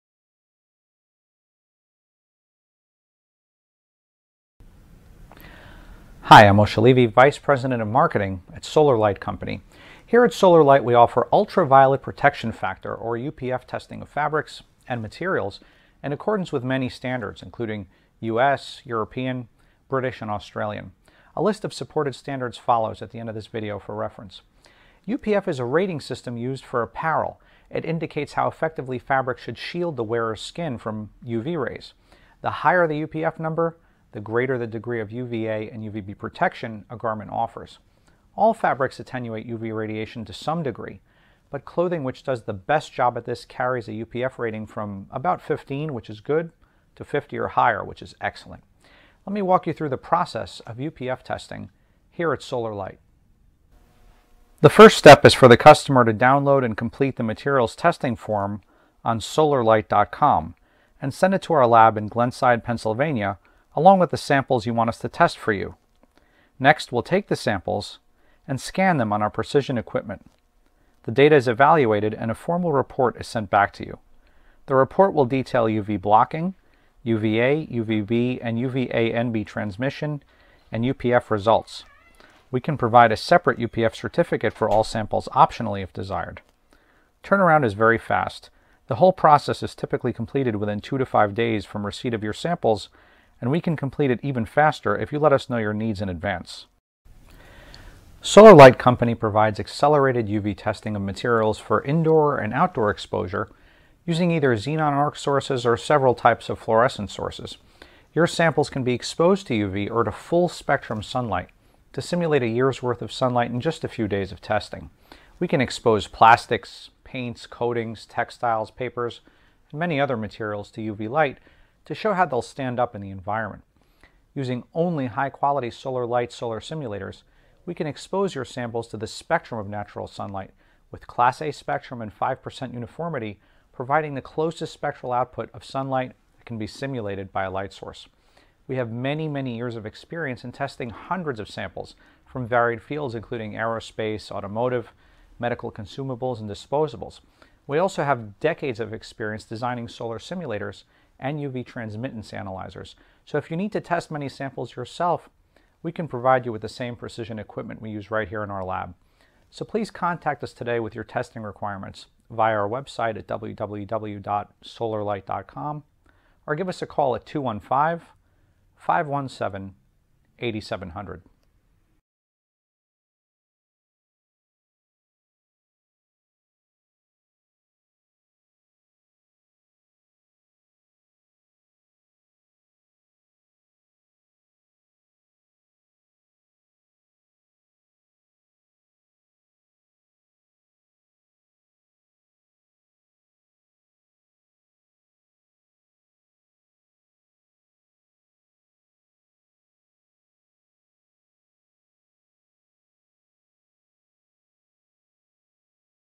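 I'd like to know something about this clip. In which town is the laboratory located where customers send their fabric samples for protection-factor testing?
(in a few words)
Glenside.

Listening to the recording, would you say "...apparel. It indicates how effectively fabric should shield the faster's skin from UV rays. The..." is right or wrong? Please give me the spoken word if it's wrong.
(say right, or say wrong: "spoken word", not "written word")
wrong: "wearer", not "faster".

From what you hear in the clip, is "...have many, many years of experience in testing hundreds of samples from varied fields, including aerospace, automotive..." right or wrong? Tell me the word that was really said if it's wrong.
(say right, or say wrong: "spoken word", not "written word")
right.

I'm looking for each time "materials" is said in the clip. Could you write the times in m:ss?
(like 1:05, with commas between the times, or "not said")
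0:15, 0:57, 1:41, 2:00.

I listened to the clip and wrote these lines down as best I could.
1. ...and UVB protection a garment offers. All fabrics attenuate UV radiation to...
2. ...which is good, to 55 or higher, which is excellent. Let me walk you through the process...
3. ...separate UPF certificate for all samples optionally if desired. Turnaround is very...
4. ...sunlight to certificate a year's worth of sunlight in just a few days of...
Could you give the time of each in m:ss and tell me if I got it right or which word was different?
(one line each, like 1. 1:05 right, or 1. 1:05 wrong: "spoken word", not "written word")
1. 0:35 right
2. 0:45 wrong: "50", not "55"
3. 1:23 right
4. 1:51 wrong: "simulate", not "certificate".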